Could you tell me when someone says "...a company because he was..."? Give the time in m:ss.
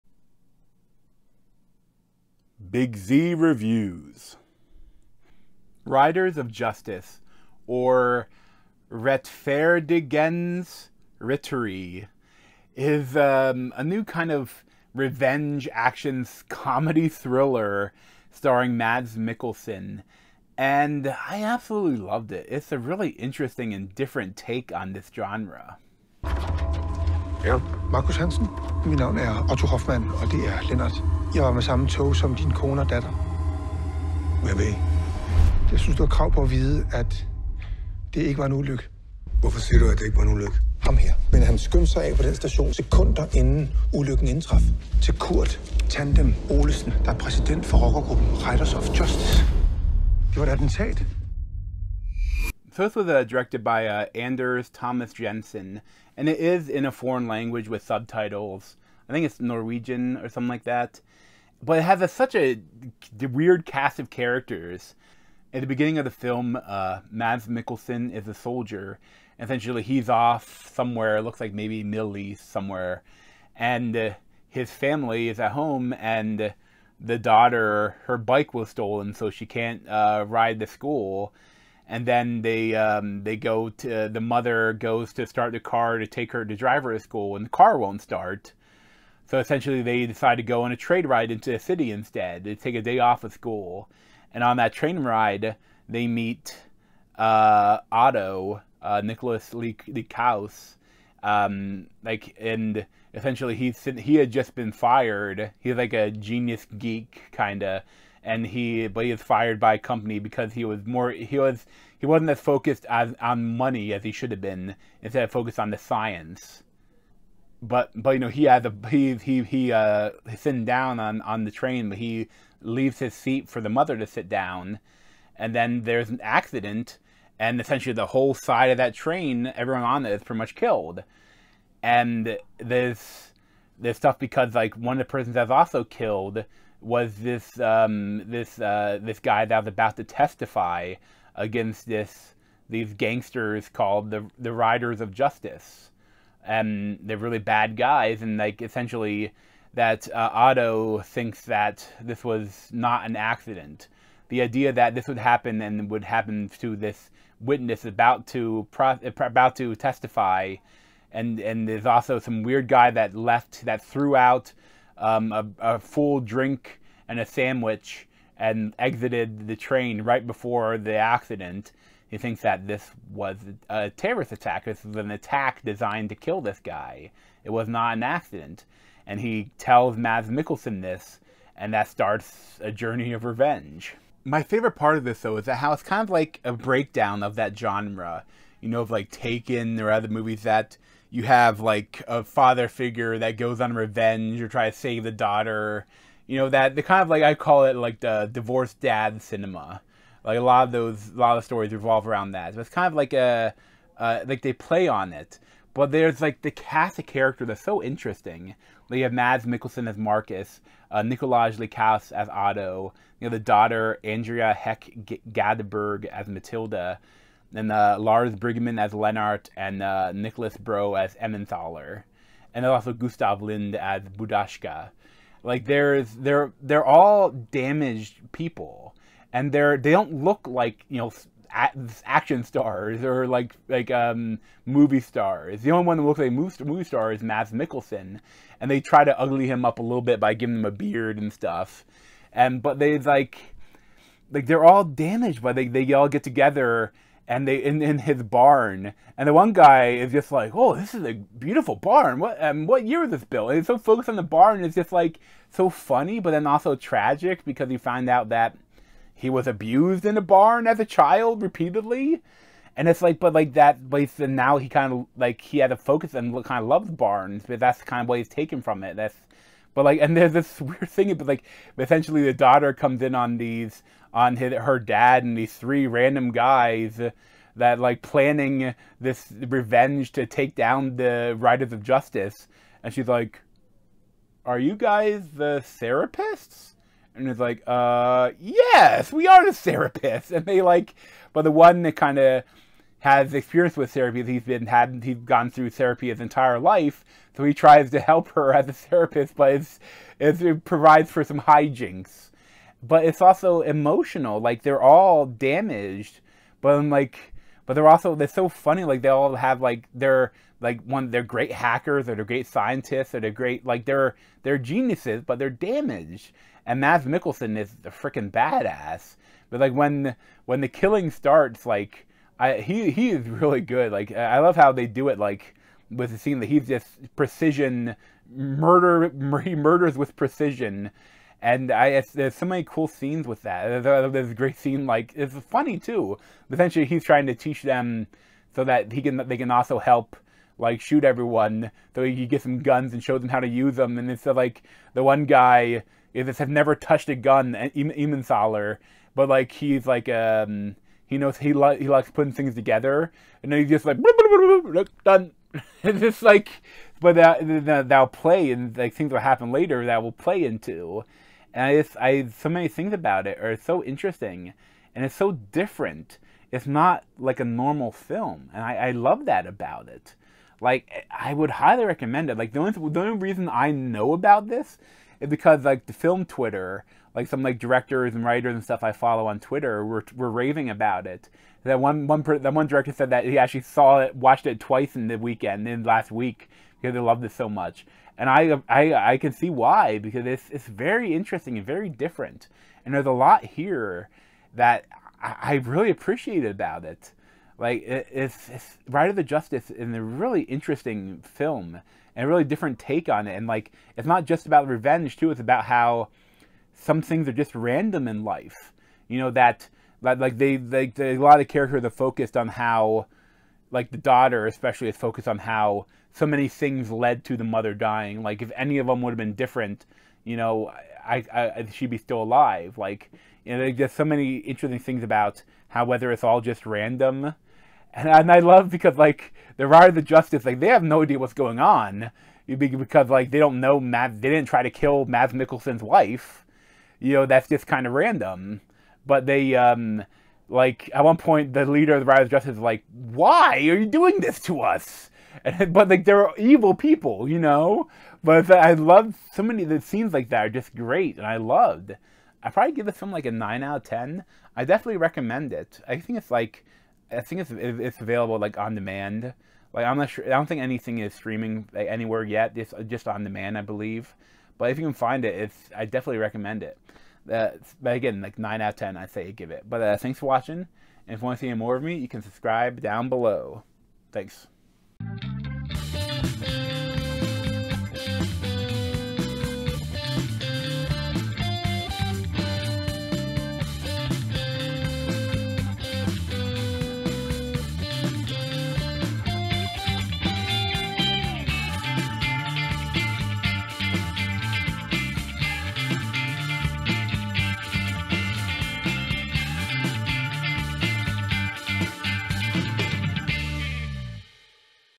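1:49.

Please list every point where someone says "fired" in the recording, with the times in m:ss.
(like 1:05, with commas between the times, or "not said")
1:44, 1:49.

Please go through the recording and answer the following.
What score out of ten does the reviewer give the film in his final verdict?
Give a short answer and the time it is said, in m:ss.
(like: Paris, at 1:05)
9, at 7:33.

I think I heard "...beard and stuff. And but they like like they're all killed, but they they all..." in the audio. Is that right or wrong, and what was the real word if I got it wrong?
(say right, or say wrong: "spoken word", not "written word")
wrong: "damaged", not "killed".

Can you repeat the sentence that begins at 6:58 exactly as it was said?
Like if any of them would have been different, you know, I, I she'd be still alive.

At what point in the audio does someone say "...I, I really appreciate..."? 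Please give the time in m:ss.
6:35.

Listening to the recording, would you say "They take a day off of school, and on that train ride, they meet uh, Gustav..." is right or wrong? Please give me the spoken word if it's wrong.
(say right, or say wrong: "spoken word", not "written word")
wrong: "Otto", not "Gustav".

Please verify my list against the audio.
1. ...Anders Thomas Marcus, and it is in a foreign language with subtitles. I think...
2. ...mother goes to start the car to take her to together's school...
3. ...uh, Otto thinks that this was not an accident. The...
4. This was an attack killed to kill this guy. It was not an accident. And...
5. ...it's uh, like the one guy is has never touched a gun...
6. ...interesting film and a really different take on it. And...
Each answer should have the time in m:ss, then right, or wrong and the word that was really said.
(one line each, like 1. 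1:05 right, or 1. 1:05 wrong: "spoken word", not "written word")
1. 0:54 wrong: "Jensen", not "Marcus"
2. 1:24 wrong: "driver", not "together"
3. 2:30 right
4. 2:54 wrong: "designed", not "killed"
5. 5:44 right
6. 6:40 right.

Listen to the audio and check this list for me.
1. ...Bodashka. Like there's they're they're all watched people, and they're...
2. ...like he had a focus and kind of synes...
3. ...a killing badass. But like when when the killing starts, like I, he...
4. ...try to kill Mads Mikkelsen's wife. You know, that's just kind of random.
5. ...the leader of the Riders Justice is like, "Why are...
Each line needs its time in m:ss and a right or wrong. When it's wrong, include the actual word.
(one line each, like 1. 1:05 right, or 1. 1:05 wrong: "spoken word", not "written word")
1. 3:44 wrong: "damaged", not "watched"
2. 4:25 wrong: "loves", not "synes"
3. 5:17 wrong: "freaking", not "killing"
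4. 7:14 right
5. 7:21 right.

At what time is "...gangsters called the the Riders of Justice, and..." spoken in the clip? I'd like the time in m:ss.
2:22.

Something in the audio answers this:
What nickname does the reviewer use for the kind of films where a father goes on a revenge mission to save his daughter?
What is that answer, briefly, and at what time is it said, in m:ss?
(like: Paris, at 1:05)
divorced dad cinema, at 3:18.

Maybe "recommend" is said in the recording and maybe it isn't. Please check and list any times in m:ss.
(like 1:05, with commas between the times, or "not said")
6:11, 7:34, 7:46.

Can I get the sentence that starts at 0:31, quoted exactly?
Jeg var med samme tog som din kone og datter.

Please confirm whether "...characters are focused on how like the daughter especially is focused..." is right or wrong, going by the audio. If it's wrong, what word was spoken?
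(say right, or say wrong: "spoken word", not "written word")
right.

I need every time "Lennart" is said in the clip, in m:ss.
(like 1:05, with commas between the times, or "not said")
0:30, 3:38.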